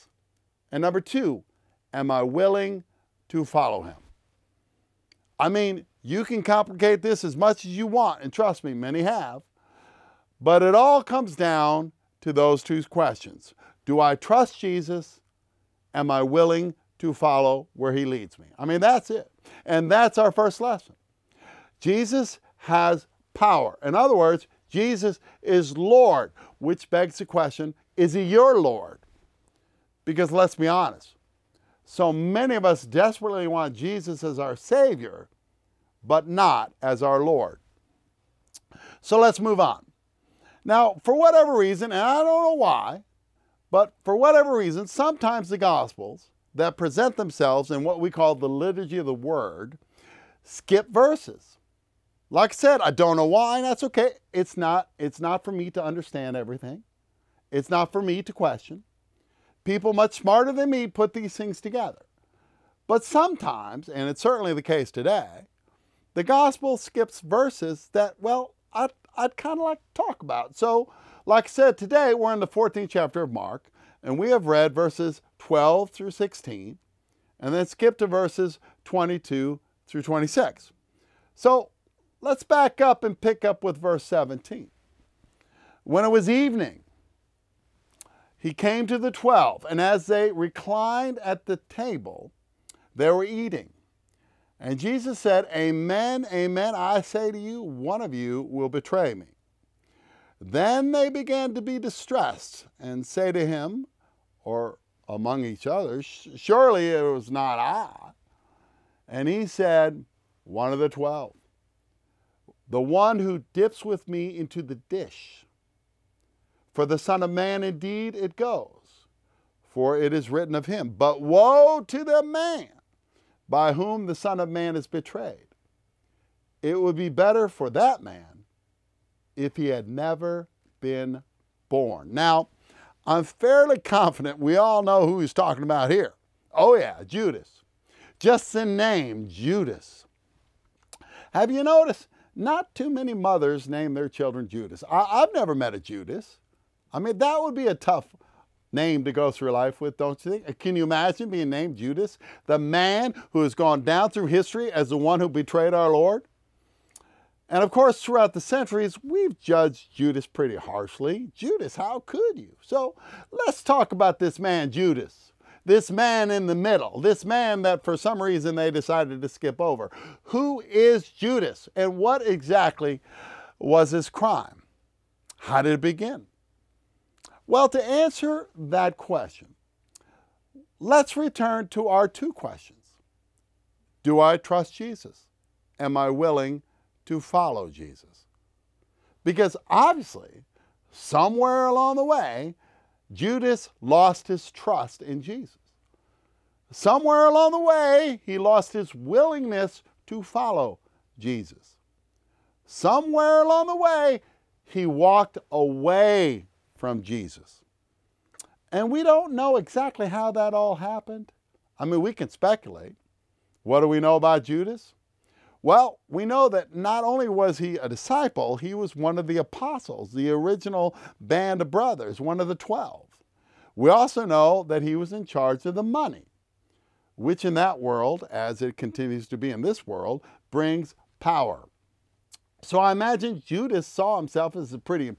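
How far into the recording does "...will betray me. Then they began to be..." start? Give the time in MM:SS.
01:38.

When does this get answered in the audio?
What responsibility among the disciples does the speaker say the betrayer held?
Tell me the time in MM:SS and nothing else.
03:45.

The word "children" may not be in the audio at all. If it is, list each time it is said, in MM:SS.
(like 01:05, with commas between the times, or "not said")
02:24.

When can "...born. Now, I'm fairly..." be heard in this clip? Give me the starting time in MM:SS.
02:11.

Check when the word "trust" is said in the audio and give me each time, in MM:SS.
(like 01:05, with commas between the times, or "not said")
00:08, 00:14, 03:04, 03:14.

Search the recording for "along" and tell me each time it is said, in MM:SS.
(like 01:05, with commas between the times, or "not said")
03:11, 03:17, 03:23.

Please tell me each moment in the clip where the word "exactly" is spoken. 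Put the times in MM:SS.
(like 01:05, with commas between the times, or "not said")
02:52, 03:29.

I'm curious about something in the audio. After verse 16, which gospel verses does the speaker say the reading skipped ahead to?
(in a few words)
Verses 22 through 26.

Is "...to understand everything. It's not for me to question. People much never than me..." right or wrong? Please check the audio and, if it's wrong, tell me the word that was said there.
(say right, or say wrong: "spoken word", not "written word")
wrong: "smarter", not "never".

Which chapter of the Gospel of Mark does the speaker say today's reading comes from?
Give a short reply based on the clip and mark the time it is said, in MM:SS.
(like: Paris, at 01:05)
14th, at 01:12.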